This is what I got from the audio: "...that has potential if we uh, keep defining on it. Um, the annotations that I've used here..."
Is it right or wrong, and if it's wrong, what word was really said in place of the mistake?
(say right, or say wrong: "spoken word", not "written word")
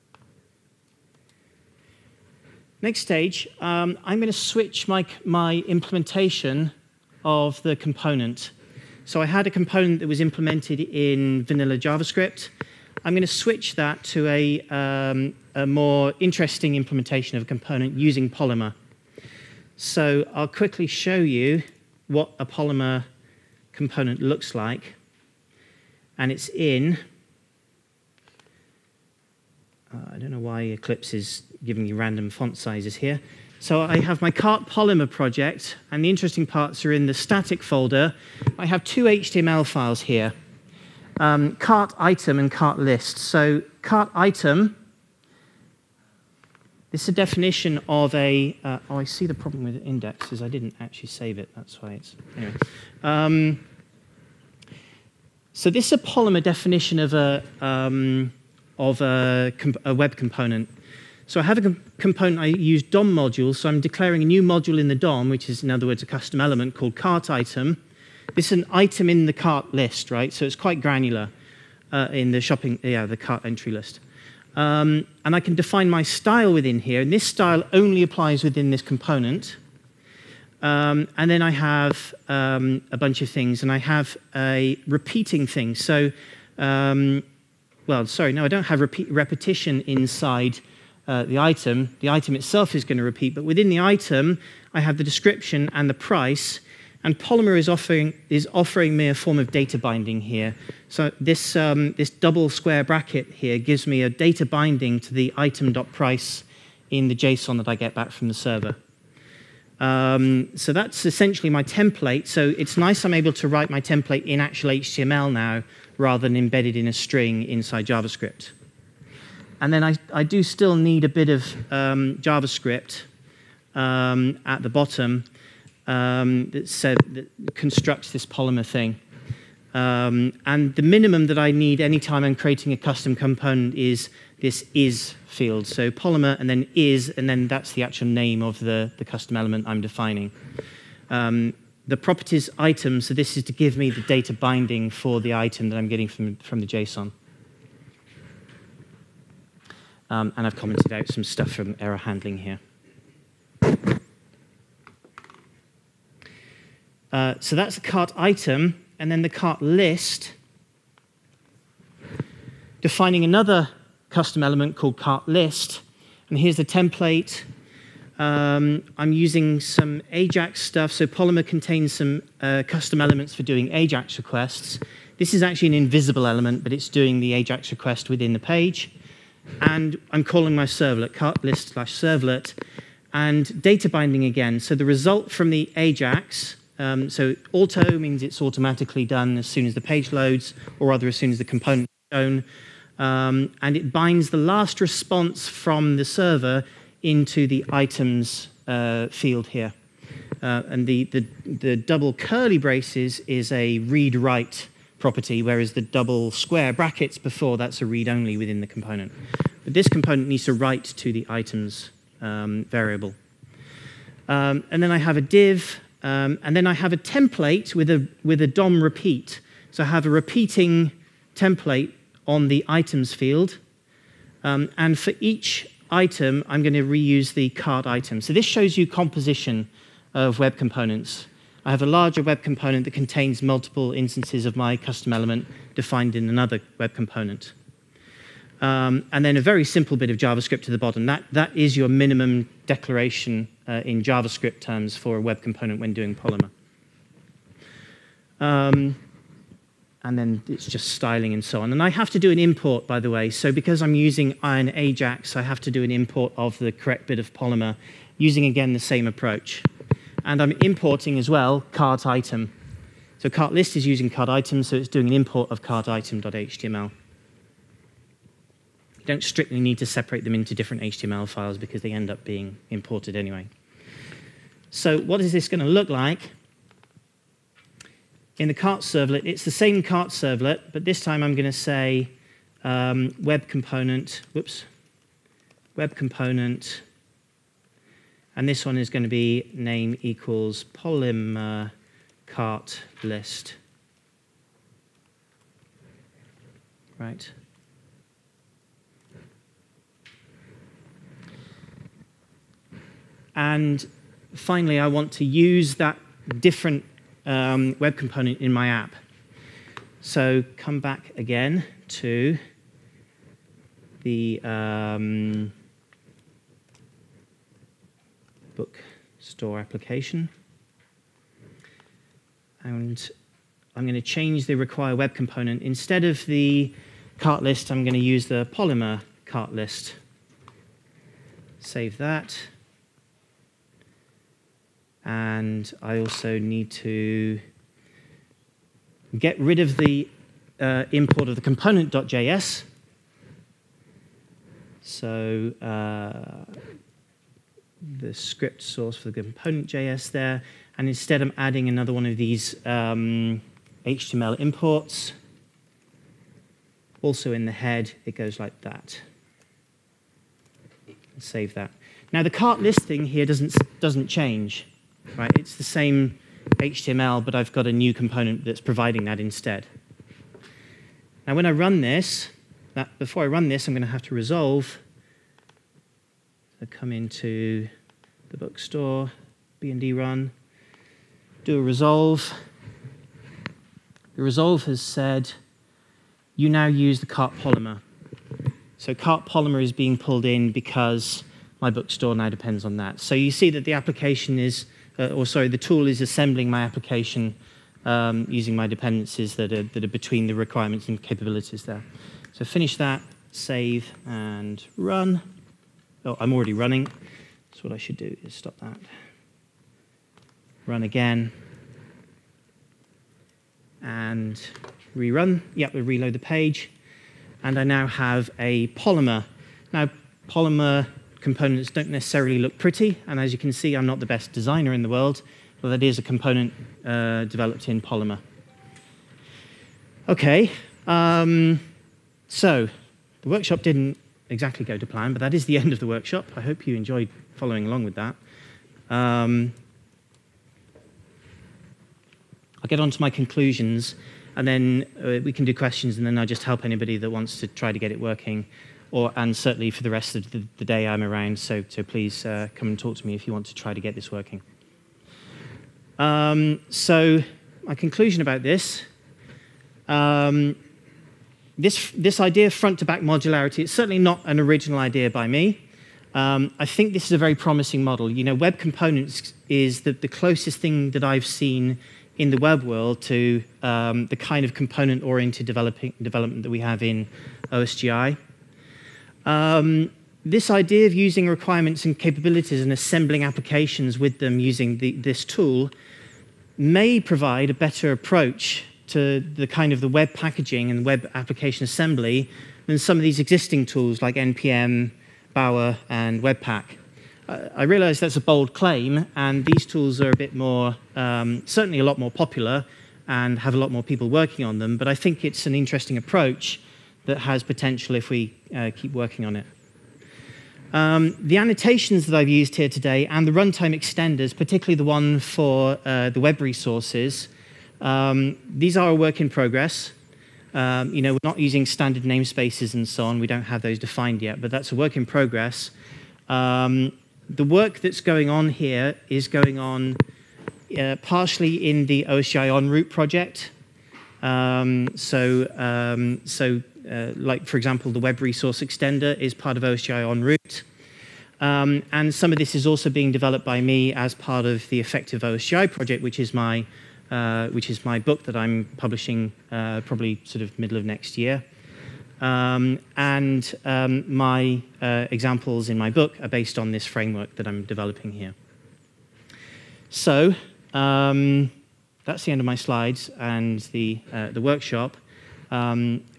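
wrong: "working", not "defining".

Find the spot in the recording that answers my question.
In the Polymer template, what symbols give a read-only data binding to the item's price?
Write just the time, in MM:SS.
01:42.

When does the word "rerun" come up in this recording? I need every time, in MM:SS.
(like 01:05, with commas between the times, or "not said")
06:54.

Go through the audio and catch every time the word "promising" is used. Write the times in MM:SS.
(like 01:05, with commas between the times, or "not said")
07:47.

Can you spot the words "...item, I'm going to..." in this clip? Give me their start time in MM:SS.
03:45.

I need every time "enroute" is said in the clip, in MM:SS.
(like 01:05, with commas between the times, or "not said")
08:52, 09:00.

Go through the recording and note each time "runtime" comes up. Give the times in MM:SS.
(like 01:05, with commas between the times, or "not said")
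08:33.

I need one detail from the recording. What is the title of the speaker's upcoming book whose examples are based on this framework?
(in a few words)
Effective OSGI.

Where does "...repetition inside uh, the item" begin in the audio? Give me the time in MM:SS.
01:29.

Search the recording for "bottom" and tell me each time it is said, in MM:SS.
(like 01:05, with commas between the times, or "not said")
02:04, 04:00.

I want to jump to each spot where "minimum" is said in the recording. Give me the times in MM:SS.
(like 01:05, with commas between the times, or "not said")
02:10, 04:01.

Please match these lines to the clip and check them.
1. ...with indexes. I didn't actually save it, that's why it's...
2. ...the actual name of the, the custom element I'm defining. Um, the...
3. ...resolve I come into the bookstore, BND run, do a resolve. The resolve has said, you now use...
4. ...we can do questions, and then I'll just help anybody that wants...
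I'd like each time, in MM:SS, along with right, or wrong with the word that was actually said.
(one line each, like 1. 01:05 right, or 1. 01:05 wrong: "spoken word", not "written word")
1. 00:49 right
2. 02:17 right
3. 06:14 right
4. 07:25 right.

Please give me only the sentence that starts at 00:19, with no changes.
So I'll quickly show you what a Polymer component looks like.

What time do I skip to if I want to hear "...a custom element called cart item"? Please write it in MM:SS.
01:06.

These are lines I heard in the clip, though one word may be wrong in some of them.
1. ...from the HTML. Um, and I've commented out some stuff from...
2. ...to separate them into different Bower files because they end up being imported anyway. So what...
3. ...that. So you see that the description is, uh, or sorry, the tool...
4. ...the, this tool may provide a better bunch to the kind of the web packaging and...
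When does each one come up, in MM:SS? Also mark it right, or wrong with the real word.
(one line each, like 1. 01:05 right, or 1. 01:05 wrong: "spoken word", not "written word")
1. 02:26 wrong: "JSON", not "HTML"
2. 04:29 wrong: "HTML", not "Bower"
3. 06:32 wrong: "application", not "description"
4. 08:04 wrong: "approach", not "bunch".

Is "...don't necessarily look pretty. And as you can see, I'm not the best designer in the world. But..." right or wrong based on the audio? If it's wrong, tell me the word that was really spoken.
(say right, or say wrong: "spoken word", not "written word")
right.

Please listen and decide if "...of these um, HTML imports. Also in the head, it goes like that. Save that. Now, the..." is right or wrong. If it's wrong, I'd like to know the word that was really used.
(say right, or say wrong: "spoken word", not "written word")
right.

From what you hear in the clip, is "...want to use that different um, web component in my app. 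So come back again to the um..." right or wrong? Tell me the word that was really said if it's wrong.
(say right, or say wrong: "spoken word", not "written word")
right.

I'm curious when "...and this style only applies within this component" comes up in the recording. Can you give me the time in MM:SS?
01:17.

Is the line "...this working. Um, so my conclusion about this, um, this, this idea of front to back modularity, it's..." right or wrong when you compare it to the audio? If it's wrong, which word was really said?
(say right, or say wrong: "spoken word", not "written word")
right.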